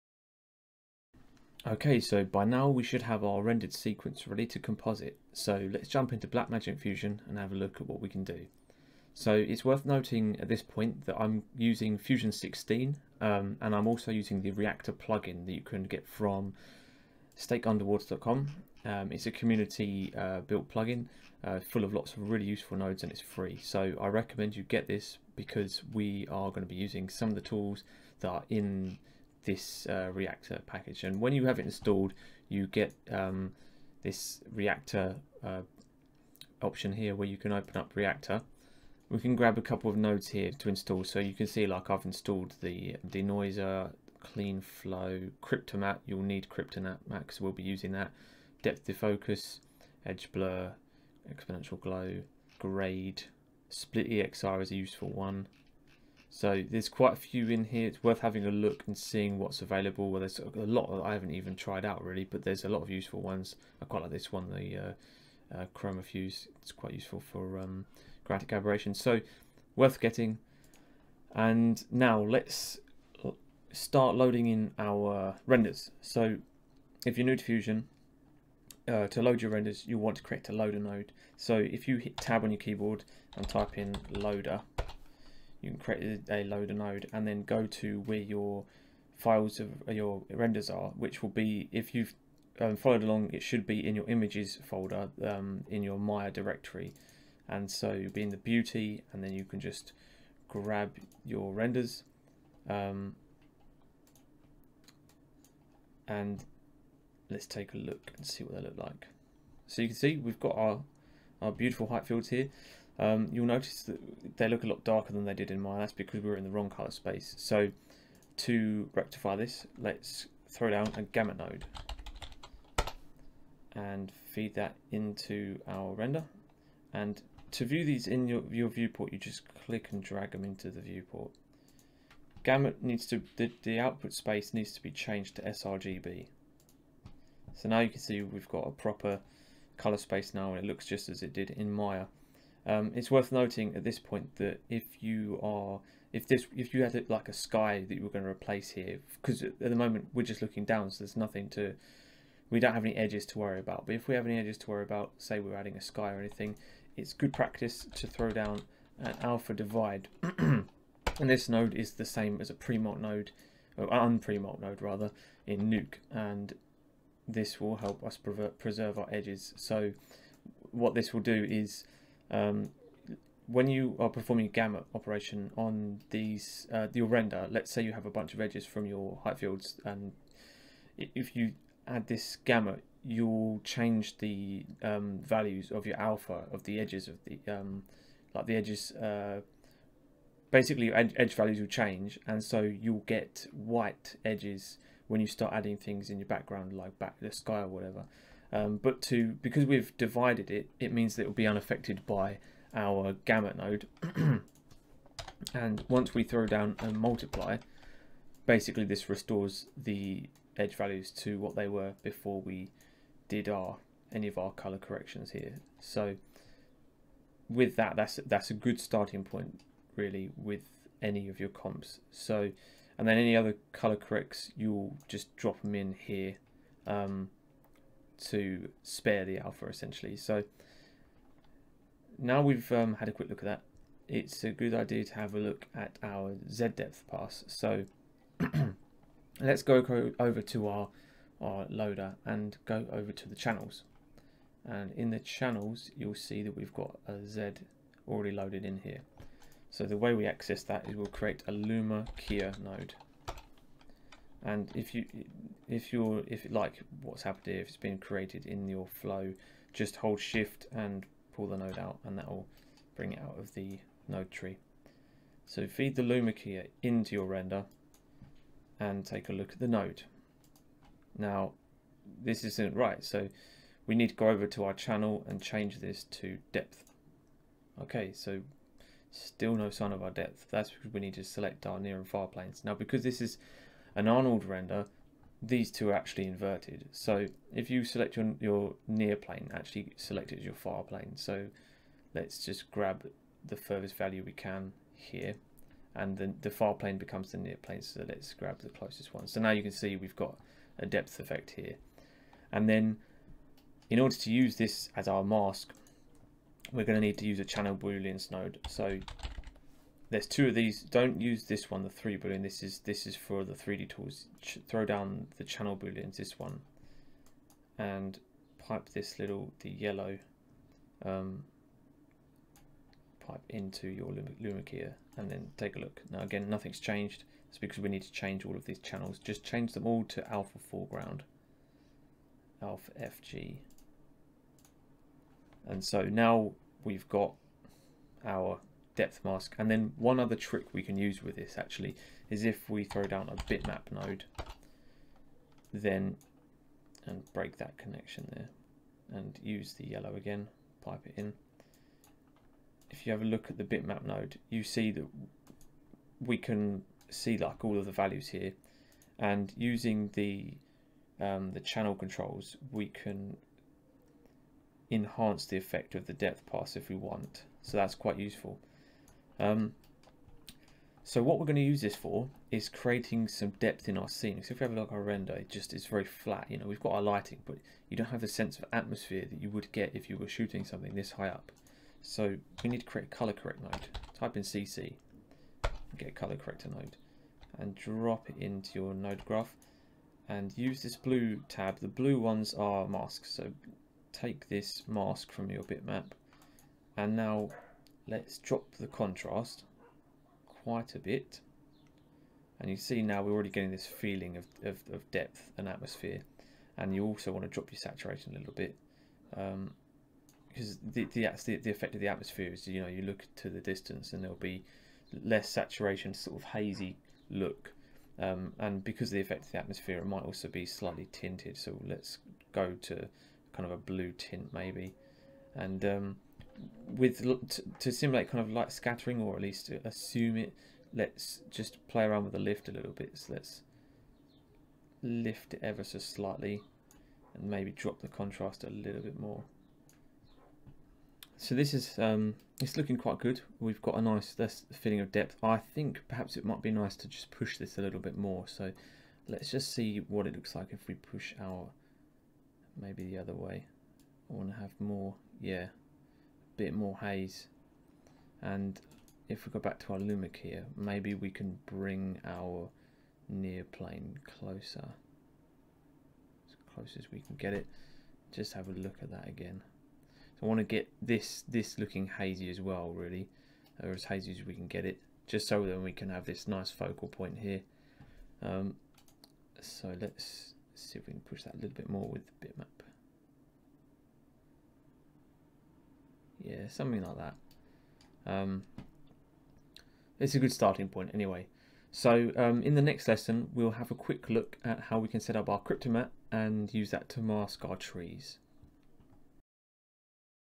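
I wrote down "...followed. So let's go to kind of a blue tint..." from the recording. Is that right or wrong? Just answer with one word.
wrong.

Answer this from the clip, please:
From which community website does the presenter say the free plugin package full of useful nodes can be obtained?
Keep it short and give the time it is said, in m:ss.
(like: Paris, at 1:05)
steakunderwater.com, at 0:17.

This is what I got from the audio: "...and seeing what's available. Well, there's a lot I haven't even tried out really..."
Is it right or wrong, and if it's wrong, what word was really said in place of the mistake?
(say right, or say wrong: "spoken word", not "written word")
right.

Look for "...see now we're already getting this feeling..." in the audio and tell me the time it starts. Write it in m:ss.
6:42.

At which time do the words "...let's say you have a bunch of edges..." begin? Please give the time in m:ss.
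2:57.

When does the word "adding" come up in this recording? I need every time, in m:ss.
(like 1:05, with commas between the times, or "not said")
2:35, 3:15.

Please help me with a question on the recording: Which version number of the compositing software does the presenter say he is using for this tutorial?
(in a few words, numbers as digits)
16.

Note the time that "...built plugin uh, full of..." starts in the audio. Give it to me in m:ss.
0:20.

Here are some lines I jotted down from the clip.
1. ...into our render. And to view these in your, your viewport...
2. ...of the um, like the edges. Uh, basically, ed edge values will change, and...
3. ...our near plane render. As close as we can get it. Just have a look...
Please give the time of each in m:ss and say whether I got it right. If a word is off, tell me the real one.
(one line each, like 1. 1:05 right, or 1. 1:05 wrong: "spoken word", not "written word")
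1. 2:04 right
2. 3:07 right
3. 7:42 wrong: "closer", not "render".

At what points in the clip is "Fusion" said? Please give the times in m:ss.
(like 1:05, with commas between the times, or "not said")
0:06, 0:11, 1:17.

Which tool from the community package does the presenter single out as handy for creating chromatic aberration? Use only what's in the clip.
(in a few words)
Chroma Fuse.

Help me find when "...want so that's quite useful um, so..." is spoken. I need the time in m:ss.
6:06.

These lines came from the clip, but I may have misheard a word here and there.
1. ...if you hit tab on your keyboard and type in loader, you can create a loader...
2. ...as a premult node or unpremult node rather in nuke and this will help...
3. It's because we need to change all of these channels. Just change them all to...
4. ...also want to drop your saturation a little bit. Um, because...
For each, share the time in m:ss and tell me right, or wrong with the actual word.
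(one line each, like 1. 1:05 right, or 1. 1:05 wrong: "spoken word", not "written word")
1. 1:21 right
2. 2:42 right
3. 5:27 right
4. 6:47 right.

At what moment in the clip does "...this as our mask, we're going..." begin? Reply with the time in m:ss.
5:04.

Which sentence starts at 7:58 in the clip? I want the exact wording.
Um, so let's see if we can push that a little bit more with the bitmap.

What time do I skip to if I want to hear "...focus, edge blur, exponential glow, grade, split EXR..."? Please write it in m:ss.
0:48.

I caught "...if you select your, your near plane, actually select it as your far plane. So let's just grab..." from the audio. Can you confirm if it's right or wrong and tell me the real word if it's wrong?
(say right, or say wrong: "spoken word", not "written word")
right.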